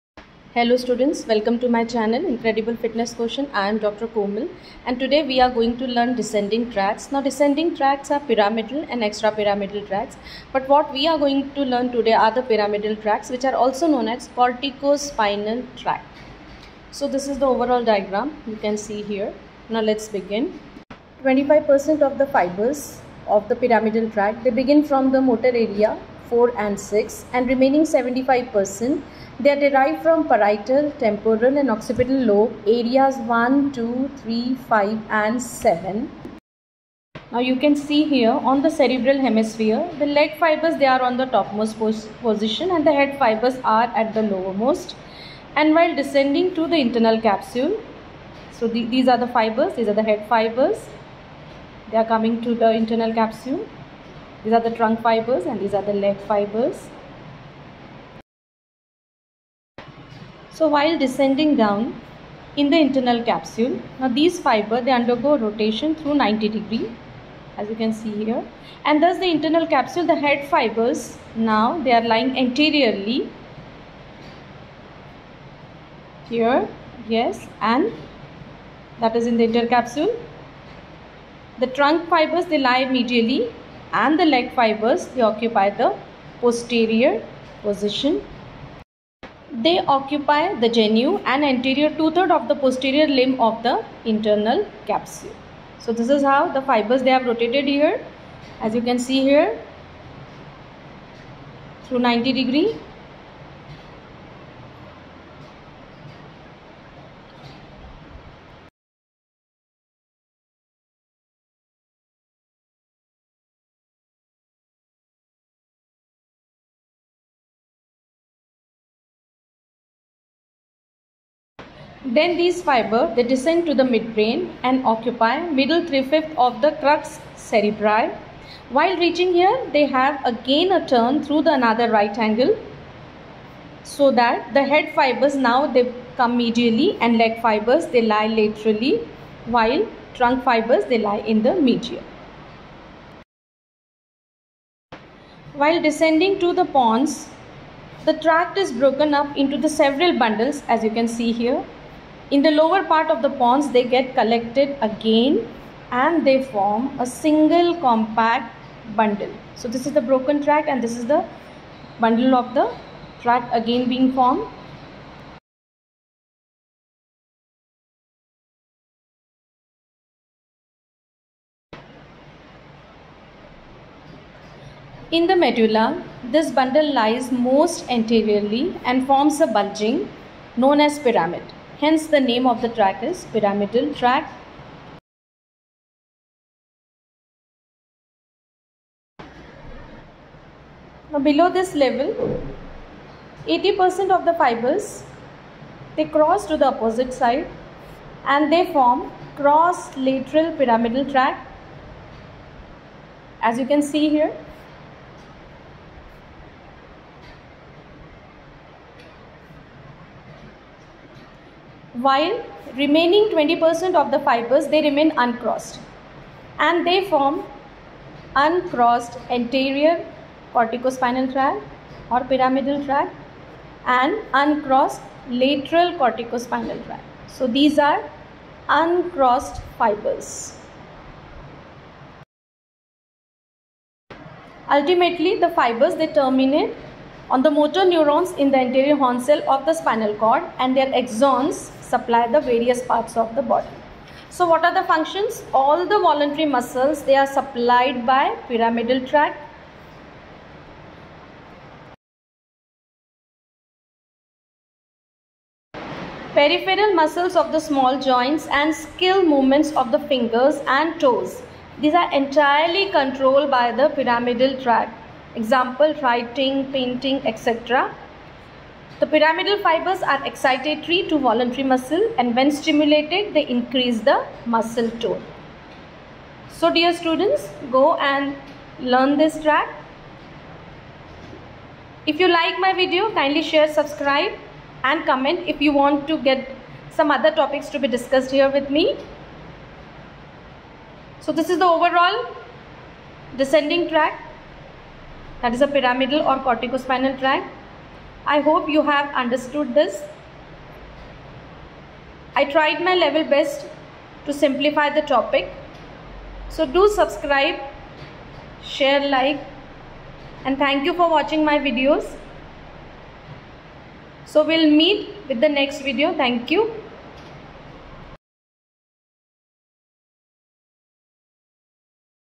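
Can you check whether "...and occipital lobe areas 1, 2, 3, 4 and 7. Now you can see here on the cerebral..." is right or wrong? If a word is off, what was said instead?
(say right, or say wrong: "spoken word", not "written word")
wrong: "5", not "4".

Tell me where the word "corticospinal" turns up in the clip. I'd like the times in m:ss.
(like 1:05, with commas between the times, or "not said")
0:14, 3:40, 3:45, 4:56.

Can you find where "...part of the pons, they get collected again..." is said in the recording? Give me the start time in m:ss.
2:32.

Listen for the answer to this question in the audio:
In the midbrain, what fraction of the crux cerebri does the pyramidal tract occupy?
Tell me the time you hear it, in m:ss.
2:05.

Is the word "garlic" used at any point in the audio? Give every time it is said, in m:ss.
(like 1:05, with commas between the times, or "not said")
not said.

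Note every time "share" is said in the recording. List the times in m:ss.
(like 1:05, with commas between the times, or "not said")
4:43, 5:08.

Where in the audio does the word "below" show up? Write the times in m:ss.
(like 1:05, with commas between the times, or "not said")
3:11.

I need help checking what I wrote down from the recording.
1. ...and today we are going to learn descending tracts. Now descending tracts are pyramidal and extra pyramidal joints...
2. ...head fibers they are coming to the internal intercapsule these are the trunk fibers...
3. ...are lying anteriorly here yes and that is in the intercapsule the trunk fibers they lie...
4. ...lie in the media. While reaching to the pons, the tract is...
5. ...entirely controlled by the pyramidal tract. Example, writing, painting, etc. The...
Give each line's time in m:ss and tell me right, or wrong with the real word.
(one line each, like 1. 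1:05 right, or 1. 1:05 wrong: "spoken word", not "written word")
1. 0:04 wrong: "tracts", not "joints"
2. 0:50 wrong: "capsule", not "intercapsule"
3. 1:11 right
4. 2:20 wrong: "descending", not "reaching"
5. 4:22 right.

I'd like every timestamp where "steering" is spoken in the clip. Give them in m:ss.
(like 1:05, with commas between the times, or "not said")
not said.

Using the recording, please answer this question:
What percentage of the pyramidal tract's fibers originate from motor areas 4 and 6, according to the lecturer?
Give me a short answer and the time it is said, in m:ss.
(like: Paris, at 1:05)
25%, at 0:21.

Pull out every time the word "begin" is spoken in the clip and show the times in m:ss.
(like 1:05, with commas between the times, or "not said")
0:20, 0:24.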